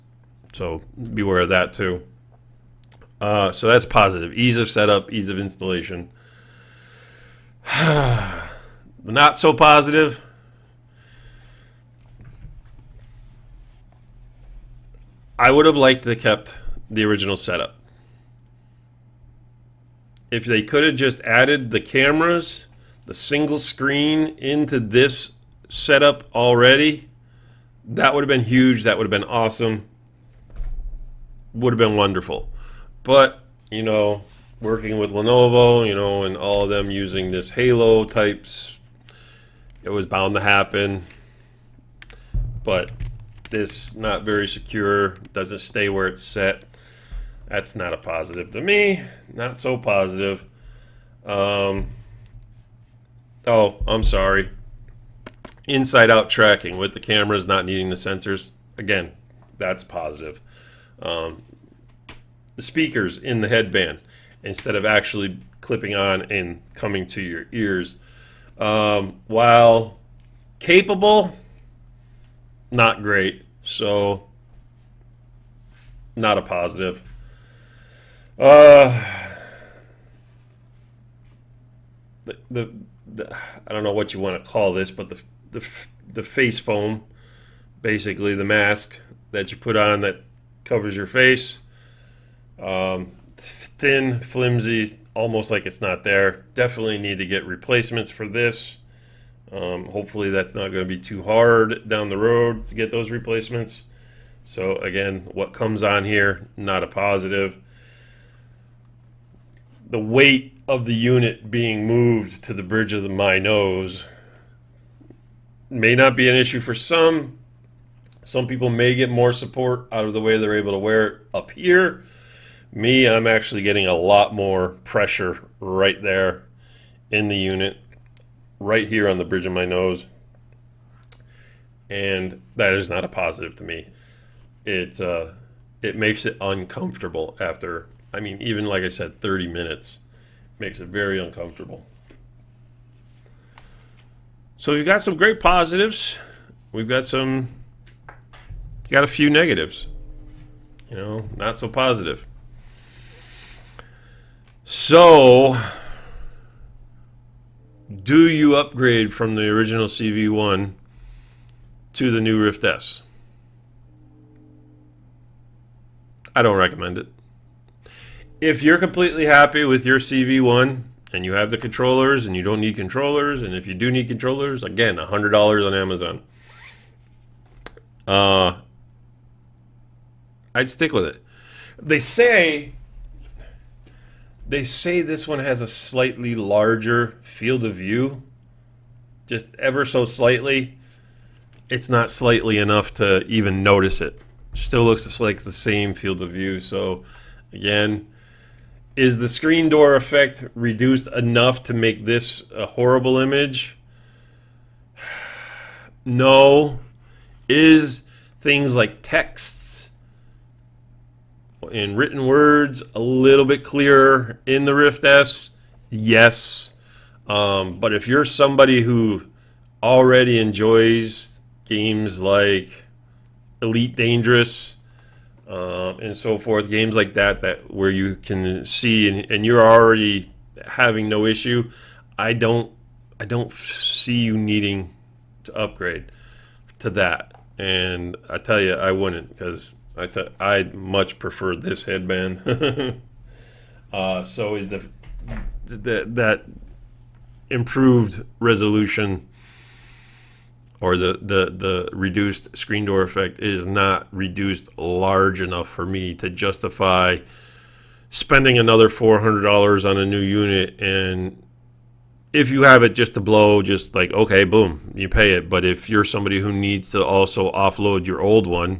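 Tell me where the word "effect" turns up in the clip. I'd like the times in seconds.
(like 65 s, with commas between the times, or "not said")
199 s, 253 s.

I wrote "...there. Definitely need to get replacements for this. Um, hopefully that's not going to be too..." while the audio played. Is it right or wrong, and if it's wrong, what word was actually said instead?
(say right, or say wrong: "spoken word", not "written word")
right.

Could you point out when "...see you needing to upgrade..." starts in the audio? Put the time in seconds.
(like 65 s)
233 s.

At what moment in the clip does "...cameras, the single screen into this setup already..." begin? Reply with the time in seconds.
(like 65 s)
21 s.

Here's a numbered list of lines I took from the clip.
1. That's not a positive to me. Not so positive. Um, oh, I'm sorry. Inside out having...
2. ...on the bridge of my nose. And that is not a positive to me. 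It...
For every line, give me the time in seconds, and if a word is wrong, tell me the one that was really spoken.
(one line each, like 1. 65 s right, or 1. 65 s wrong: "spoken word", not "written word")
1. 47 s wrong: "tracking", not "having"
2. 129 s right.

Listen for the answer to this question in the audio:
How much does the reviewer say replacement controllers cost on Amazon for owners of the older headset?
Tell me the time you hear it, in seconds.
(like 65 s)
174 s.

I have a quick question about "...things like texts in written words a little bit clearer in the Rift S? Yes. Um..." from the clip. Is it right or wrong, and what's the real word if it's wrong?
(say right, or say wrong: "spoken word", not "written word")
right.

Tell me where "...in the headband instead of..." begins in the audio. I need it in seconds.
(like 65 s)
63 s.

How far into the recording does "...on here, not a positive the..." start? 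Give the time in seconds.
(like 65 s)
105 s.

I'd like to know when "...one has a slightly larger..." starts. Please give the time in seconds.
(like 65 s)
185 s.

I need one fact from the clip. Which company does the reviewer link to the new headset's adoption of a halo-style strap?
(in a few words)
Lenovo.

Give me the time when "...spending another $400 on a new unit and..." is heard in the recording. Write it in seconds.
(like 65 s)
258 s.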